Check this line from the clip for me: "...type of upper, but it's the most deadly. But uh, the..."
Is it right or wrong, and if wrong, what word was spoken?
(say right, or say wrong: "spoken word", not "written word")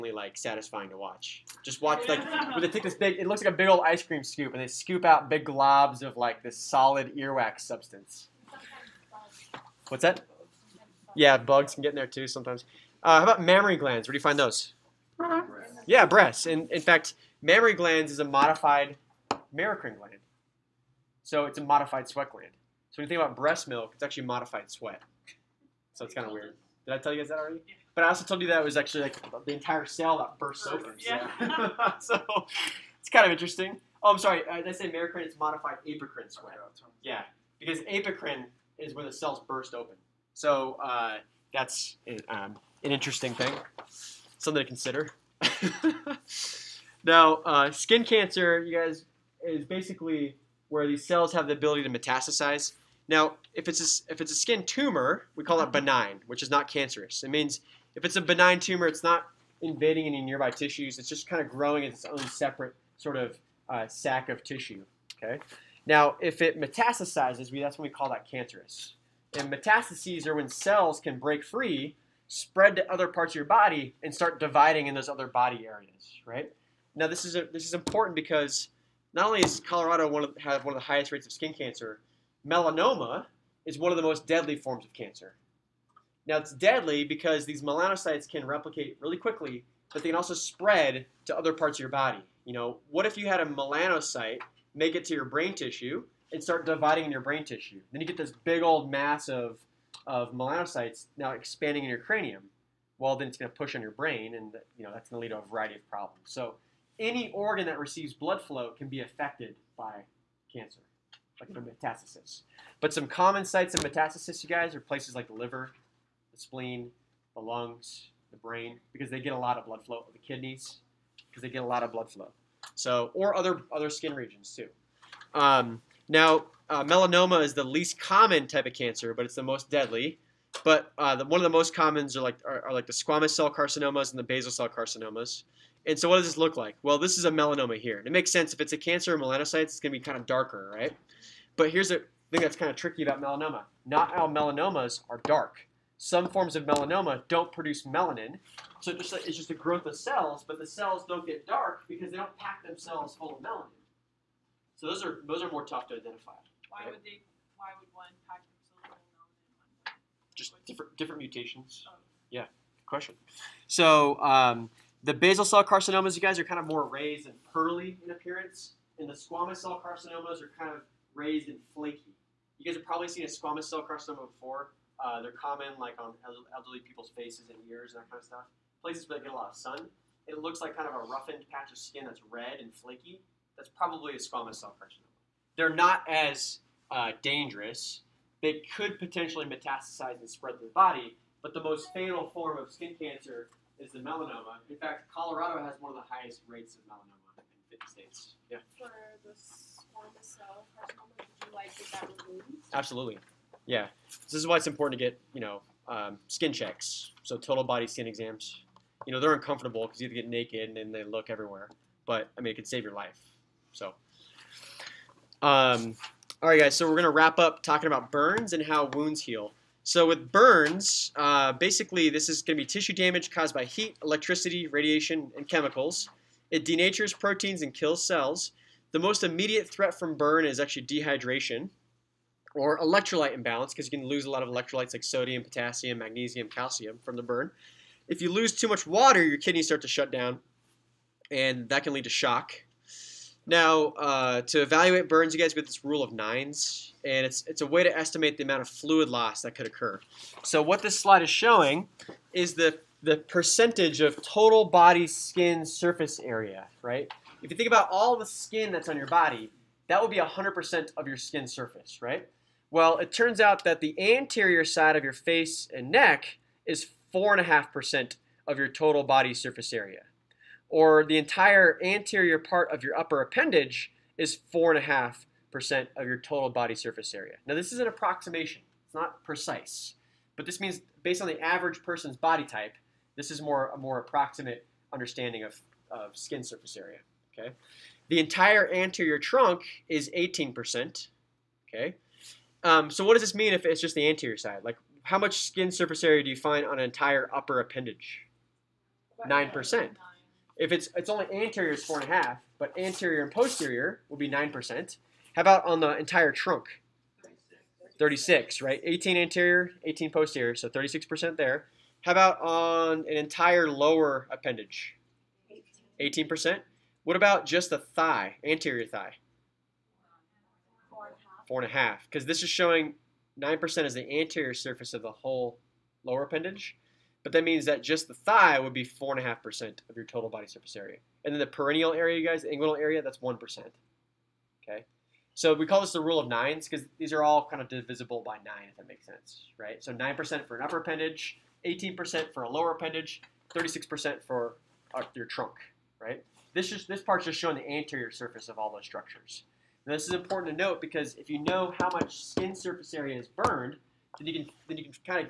wrong: "cancer", not "upper".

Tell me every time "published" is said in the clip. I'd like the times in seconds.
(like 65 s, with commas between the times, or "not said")
not said.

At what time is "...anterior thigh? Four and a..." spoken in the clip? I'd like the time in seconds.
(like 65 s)
318 s.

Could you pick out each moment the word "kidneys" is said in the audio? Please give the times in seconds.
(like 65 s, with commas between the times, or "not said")
120 s, 239 s.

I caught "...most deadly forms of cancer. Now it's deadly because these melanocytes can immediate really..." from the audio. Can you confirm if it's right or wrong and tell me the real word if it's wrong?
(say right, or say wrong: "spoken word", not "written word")
wrong: "replicate", not "immediate".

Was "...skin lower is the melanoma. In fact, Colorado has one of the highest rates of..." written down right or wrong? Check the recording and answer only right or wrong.
wrong.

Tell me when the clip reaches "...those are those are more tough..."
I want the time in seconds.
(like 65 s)
154 s.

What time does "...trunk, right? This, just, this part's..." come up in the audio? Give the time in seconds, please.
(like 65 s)
345 s.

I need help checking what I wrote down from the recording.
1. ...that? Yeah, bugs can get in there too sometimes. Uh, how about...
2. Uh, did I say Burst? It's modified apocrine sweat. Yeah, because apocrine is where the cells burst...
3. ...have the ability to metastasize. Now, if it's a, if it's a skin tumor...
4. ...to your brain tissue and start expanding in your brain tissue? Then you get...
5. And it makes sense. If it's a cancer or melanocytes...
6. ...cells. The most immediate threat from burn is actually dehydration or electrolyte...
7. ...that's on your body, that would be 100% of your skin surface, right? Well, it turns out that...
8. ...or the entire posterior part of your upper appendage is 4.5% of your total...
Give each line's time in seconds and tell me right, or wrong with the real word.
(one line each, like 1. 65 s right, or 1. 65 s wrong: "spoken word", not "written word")
1. 10 s right
2. 34 s wrong: "Merocrine", not "Burst"
3. 51 s right
4. 95 s wrong: "dividing", not "expanding"
5. 137 s right
6. 228 s right
7. 258 s right
8. 270 s wrong: "anterior", not "posterior".